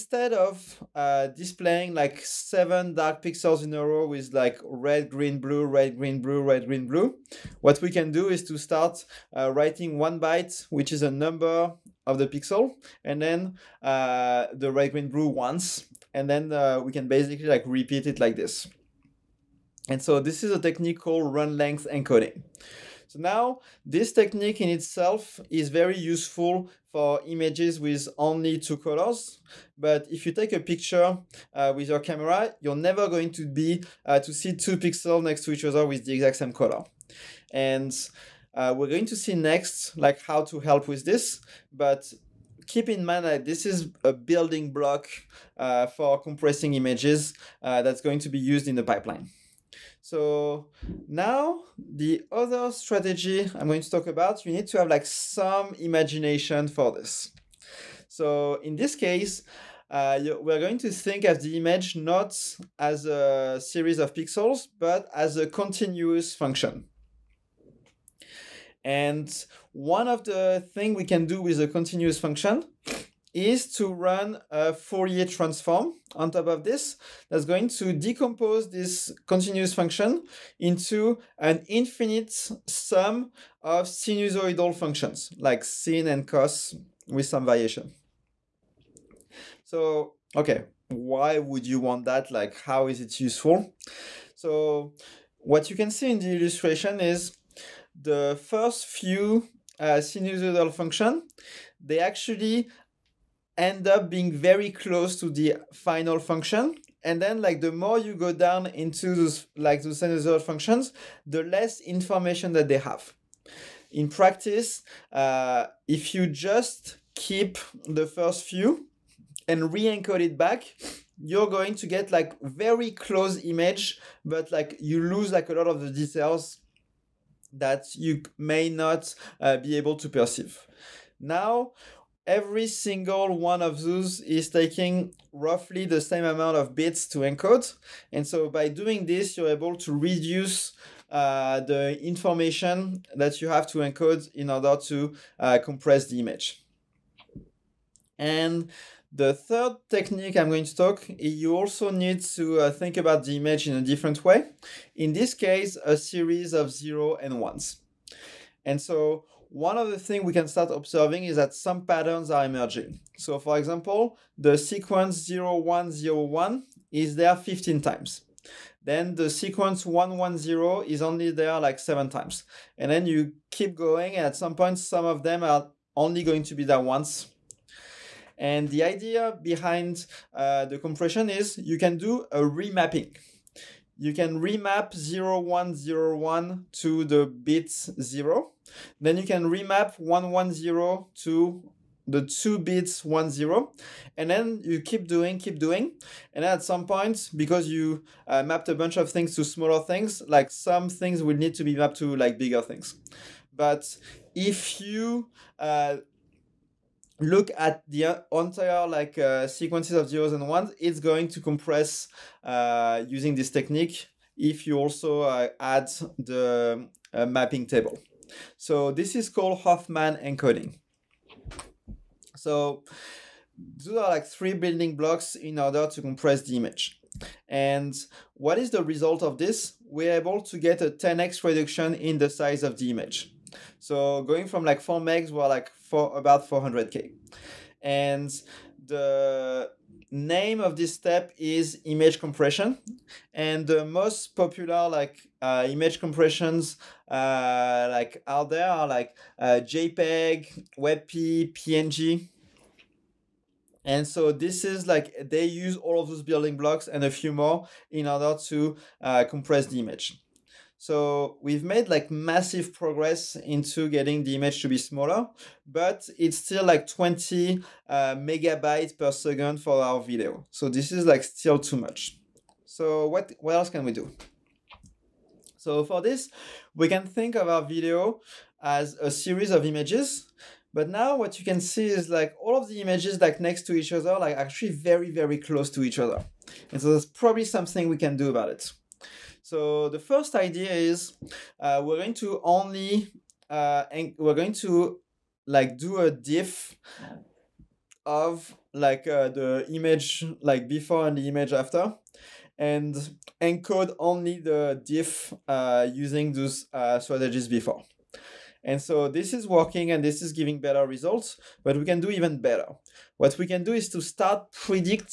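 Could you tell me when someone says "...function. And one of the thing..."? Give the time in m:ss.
1:06.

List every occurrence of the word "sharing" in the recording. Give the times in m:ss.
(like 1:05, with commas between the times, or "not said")
not said.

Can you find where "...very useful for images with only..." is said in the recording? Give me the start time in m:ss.
0:25.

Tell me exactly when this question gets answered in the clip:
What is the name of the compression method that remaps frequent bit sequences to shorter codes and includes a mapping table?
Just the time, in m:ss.
3:39.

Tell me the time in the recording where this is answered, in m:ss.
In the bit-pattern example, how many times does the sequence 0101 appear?
2:47.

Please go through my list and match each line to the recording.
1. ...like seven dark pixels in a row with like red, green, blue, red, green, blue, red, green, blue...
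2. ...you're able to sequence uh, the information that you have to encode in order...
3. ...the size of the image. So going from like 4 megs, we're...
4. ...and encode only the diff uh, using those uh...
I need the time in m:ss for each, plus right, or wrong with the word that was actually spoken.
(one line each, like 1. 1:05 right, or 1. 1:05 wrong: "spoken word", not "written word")
1. 0:01 right
2. 2:19 wrong: "reduce", not "sequence"
3. 3:52 right
4. 5:02 right.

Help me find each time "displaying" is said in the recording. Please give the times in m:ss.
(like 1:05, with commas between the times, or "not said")
0:01.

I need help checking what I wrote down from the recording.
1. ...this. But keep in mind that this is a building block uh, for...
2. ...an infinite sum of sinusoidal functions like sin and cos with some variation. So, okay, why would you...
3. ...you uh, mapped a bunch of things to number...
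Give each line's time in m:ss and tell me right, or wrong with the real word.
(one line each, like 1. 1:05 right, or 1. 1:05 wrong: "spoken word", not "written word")
1. 0:41 right
2. 1:21 right
3. 3:17 wrong: "smaller", not "number".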